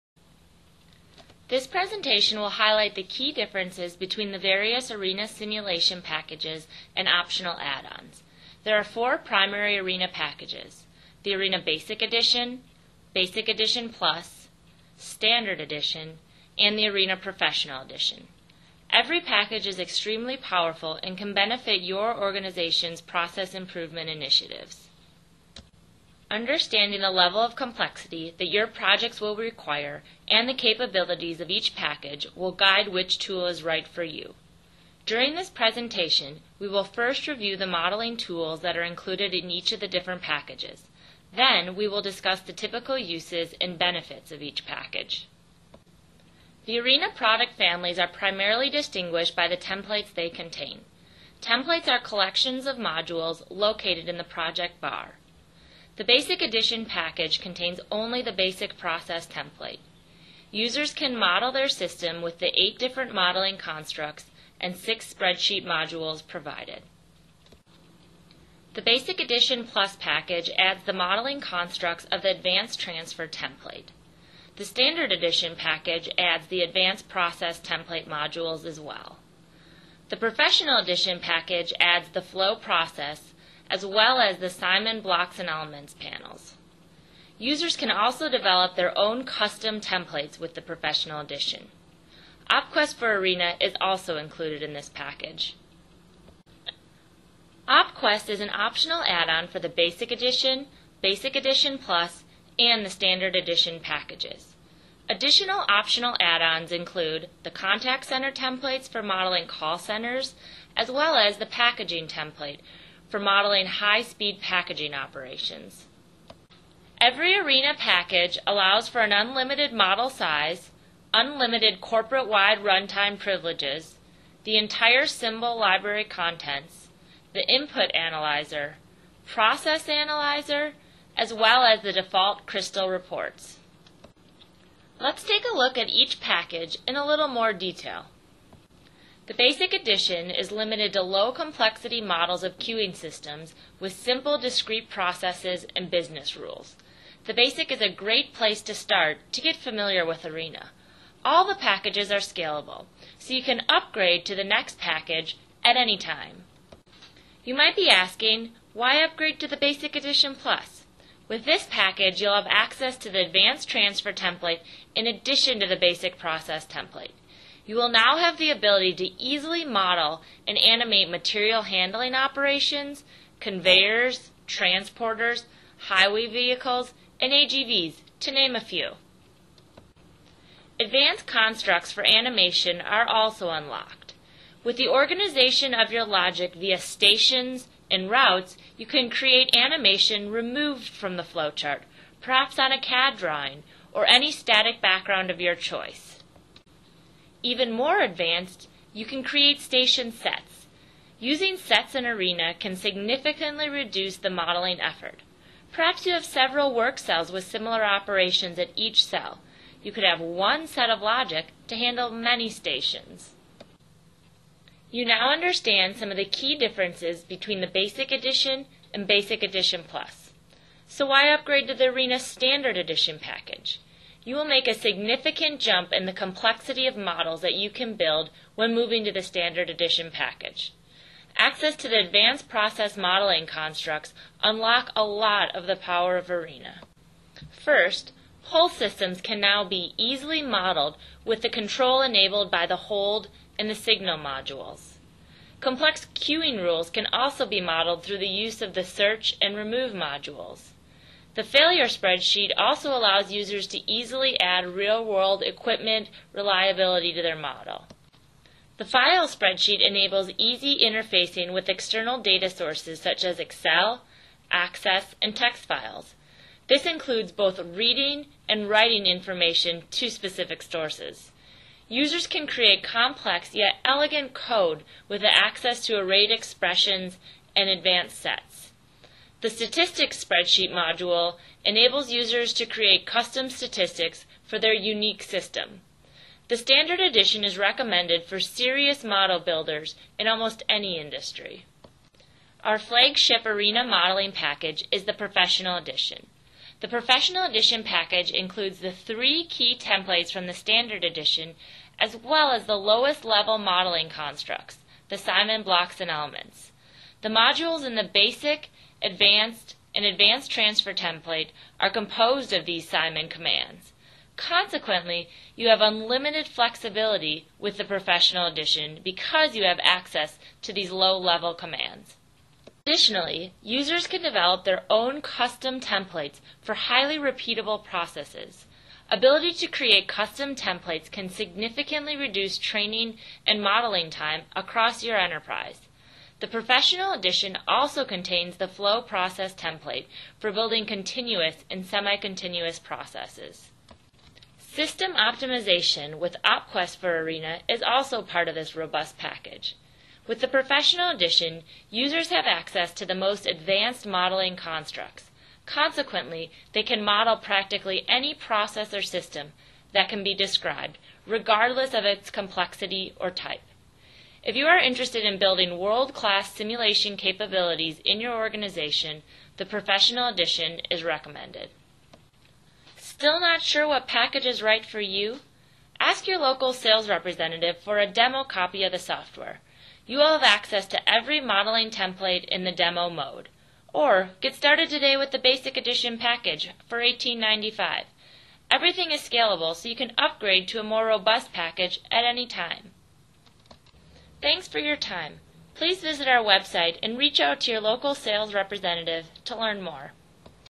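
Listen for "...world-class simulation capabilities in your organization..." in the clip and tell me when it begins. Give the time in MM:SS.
06:05.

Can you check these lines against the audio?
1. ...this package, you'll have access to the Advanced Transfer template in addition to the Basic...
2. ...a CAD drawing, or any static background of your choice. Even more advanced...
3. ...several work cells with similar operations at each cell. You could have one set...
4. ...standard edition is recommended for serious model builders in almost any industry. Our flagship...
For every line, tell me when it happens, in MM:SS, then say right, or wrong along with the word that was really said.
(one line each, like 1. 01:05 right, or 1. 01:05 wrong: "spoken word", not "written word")
1. 02:41 right
2. 03:12 right
3. 03:26 right
4. 04:46 right.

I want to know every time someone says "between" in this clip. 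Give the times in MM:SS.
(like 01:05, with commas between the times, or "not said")
00:03, 03:37.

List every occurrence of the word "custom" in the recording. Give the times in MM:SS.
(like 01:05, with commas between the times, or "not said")
01:29, 04:43, 05:25, 05:30.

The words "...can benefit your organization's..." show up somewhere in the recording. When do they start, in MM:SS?
00:21.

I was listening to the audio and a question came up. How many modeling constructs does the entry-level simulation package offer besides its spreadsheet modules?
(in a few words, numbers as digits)
8.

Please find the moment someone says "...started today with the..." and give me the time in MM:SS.
06:24.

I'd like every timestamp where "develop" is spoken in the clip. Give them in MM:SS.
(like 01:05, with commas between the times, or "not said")
01:28, 05:24.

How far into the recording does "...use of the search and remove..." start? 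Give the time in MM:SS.
04:08.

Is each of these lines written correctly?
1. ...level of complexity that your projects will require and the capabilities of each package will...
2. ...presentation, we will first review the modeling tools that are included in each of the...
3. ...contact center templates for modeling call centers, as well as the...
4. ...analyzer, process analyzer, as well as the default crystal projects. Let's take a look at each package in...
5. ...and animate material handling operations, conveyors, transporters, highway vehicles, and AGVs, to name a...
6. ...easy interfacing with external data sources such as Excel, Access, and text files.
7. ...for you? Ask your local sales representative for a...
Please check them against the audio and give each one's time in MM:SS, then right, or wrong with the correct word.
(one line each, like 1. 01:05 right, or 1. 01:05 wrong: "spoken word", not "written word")
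1. 00:27 right
2. 00:35 right
3. 01:47 right
4. 02:07 wrong: "reports", not "projects"
5. 02:50 right
6. 04:20 right
7. 06:14 right.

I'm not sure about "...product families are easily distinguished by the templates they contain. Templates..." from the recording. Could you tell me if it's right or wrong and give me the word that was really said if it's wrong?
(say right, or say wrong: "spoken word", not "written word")
wrong: "primarily", not "easily".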